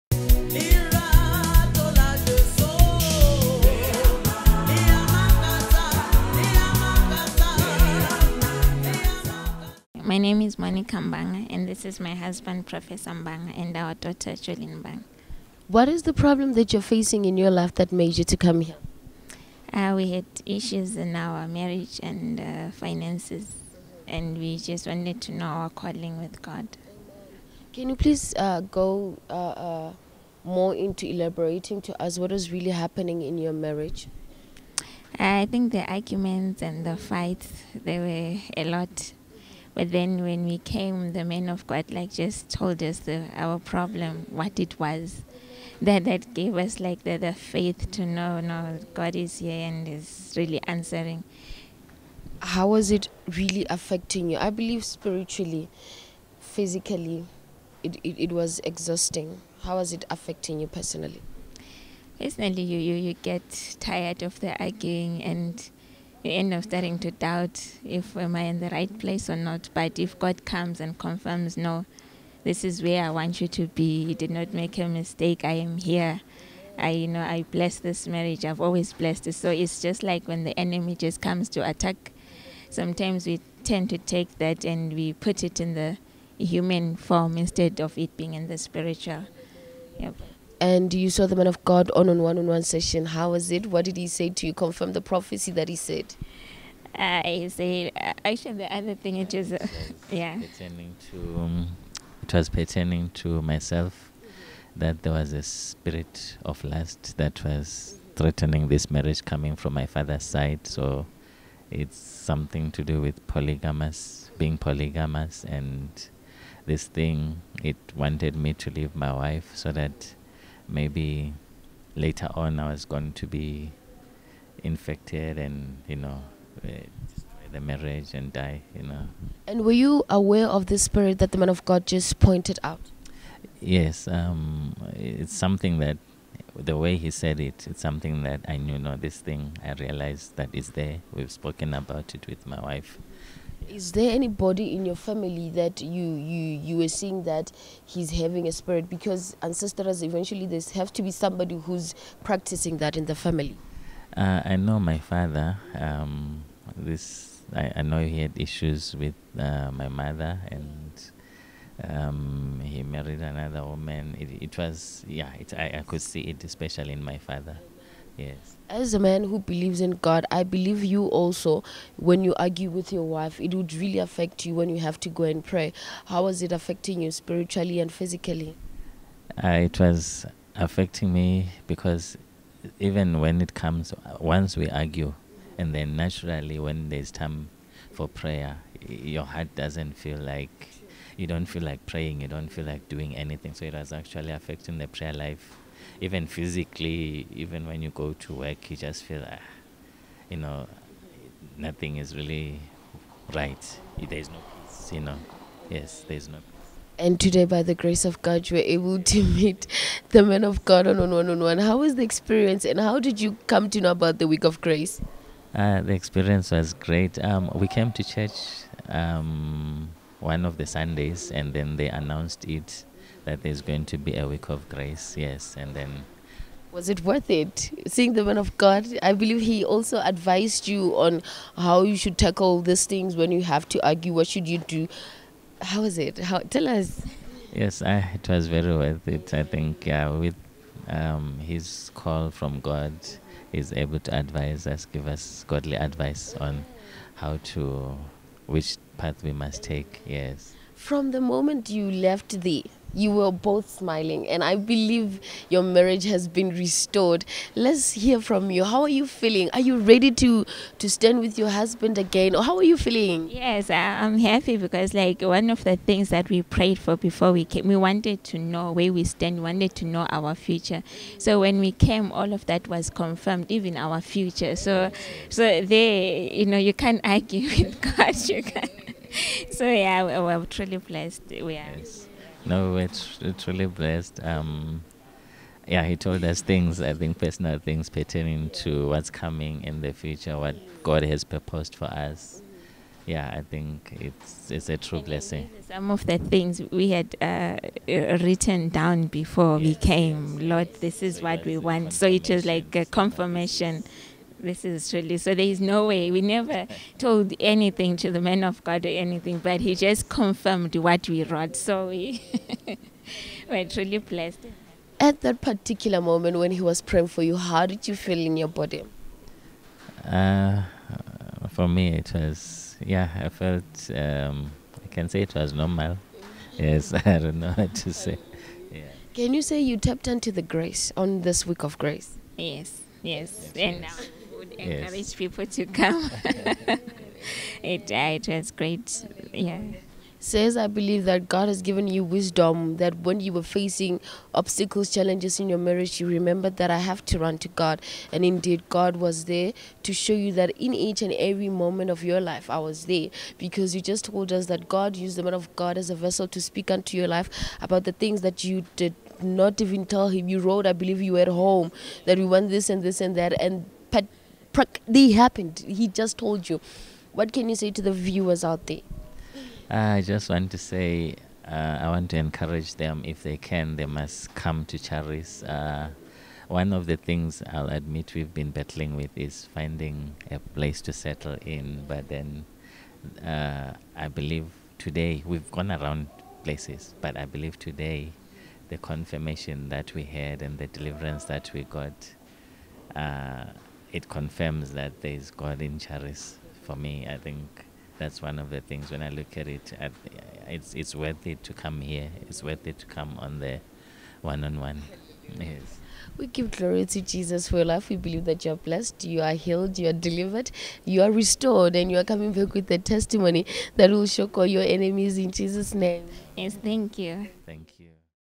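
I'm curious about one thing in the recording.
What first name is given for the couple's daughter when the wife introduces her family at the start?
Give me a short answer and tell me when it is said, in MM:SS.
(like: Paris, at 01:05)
Jolene, at 00:14.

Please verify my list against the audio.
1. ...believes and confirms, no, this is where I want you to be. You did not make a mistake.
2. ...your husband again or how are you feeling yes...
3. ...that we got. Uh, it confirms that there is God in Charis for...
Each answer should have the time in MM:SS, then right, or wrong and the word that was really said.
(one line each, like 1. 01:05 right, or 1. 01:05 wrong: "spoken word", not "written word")
1. 01:10 wrong: "comes", not "believes"
2. 04:21 right
3. 06:31 right.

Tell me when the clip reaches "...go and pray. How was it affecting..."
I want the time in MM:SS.
02:55.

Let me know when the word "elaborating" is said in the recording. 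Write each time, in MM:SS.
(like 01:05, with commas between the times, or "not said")
00:31.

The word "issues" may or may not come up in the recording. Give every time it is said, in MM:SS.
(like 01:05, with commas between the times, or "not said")
00:20, 02:38.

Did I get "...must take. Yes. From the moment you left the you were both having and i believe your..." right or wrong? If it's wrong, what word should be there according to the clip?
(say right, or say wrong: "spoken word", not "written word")
wrong: "smiling", not "having".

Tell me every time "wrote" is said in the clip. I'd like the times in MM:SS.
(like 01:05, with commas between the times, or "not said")
05:11, 06:00.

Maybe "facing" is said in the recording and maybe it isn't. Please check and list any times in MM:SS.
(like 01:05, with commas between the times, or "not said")
00:16, 05:43.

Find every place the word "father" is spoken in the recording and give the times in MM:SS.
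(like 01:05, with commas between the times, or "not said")
01:49, 02:34, 02:47.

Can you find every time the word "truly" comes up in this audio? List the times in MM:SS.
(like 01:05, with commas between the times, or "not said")
04:40, 05:04, 05:13.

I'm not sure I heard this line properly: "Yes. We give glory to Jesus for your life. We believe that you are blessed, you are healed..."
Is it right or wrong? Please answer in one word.
right.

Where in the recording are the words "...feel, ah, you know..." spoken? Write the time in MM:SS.
03:19.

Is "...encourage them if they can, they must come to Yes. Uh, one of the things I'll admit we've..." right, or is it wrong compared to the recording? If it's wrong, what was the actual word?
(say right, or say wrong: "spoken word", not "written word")
wrong: "Charis", not "Yes".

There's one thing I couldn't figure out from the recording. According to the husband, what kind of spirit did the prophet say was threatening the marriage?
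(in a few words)
spirit of lust.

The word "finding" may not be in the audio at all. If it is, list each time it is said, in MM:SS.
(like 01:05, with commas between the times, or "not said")
06:19.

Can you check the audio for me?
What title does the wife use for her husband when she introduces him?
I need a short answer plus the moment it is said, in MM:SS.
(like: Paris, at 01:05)
Professor, at 00:12.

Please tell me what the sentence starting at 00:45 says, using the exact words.
That, that gave us like the, the faith to know, no, God is here and is really answering.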